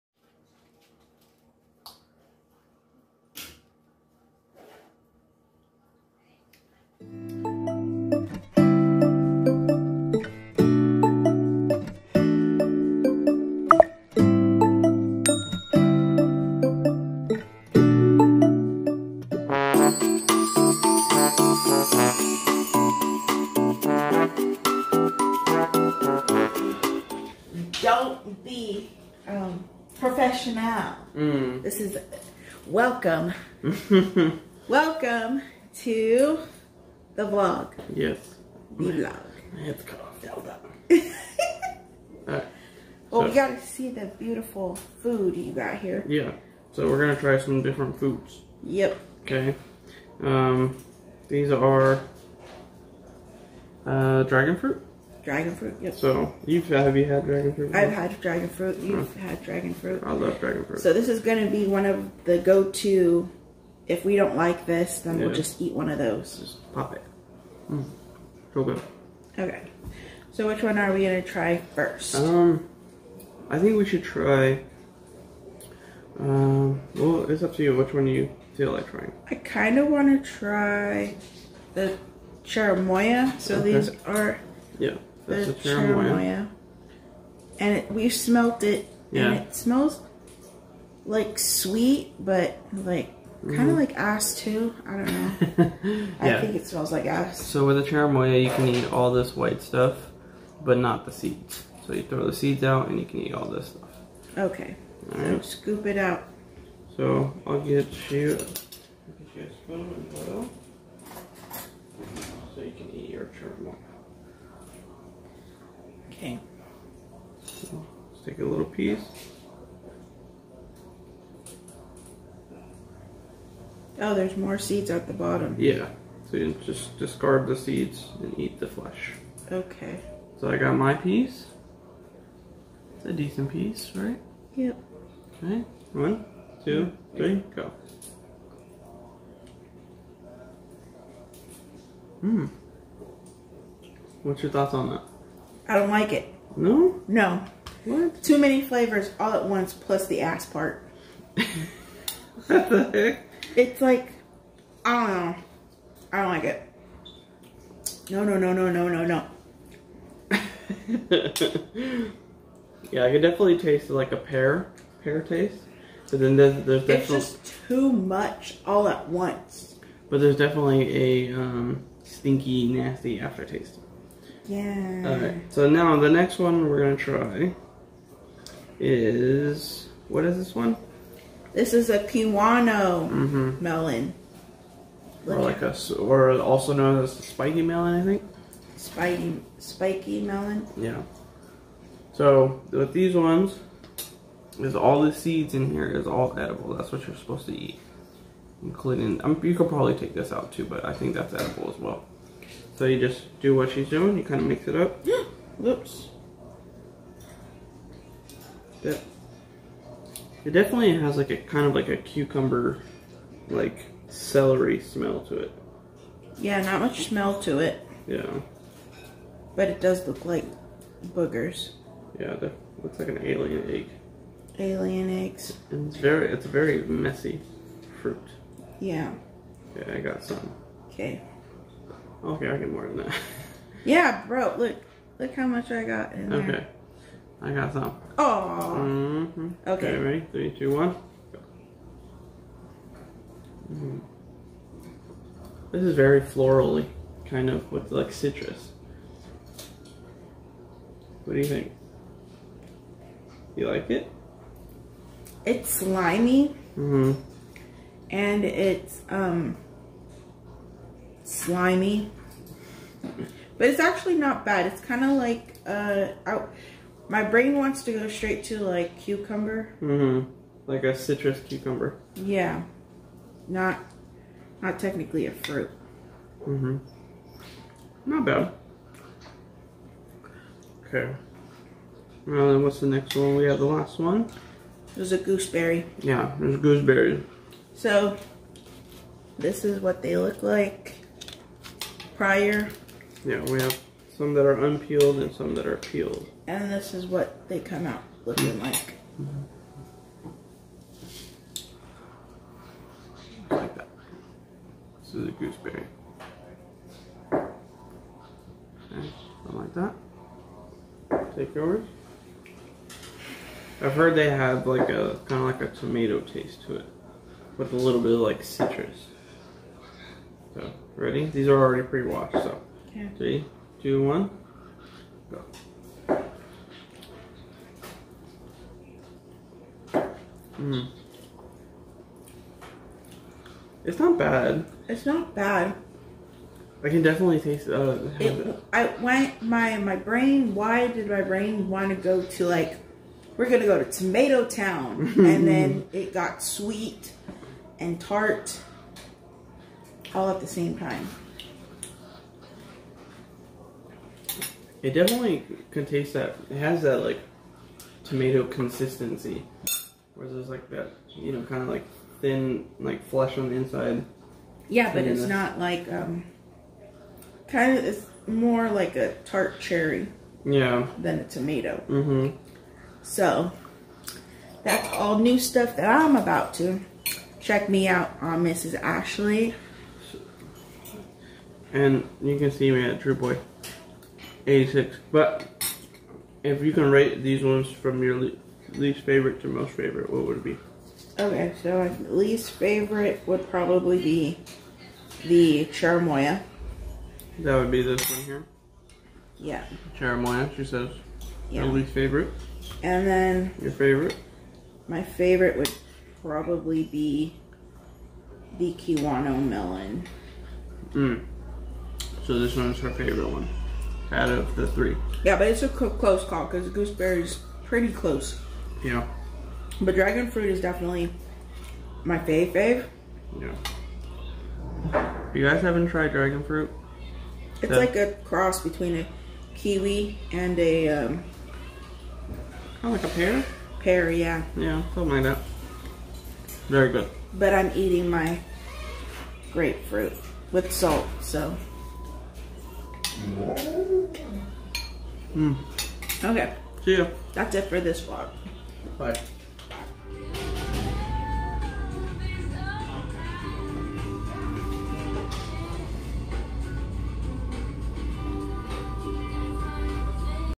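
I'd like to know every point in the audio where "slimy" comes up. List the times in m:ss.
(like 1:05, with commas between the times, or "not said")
4:15, 4:21.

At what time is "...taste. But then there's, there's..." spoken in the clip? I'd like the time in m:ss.
2:45.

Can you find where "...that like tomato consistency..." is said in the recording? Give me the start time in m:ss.
5:56.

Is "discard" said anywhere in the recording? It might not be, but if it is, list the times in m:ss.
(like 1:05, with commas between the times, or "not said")
2:06.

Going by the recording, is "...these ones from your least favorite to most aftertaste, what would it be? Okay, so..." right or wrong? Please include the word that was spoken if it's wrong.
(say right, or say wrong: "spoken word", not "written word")
wrong: "favorite", not "aftertaste".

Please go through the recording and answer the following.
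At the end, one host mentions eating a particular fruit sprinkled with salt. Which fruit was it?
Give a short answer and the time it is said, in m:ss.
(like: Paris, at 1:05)
grapefruit, at 7:19.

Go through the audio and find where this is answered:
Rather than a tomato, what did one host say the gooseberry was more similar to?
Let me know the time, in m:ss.
6:09.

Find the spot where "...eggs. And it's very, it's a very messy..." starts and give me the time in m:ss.
3:45.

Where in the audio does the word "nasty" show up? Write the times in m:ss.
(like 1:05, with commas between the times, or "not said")
2:52.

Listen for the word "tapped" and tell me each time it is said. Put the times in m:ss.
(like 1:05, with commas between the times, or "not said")
not said.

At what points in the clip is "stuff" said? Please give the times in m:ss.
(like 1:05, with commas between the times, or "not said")
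1:39, 1:43, 6:15.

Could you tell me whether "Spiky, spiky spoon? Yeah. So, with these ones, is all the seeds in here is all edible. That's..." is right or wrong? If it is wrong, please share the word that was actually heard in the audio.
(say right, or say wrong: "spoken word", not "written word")
wrong: "melon", not "spoon".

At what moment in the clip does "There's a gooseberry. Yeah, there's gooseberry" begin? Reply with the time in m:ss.
4:44.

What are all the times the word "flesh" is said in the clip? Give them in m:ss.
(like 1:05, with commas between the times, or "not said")
2:08, 6:03.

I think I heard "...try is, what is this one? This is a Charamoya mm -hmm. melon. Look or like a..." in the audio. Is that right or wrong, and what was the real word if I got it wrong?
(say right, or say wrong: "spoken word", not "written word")
wrong: "Kiwano", not "Charamoya".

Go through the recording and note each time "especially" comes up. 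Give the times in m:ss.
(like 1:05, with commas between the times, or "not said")
not said.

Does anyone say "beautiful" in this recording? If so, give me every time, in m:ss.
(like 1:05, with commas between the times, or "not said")
0:44.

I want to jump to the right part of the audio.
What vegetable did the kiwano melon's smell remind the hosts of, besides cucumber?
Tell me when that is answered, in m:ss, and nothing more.
3:34.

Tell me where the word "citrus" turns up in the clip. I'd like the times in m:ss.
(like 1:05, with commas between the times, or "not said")
4:08, 4:30, 5:18.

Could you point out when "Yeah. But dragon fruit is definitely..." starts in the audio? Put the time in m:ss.
6:58.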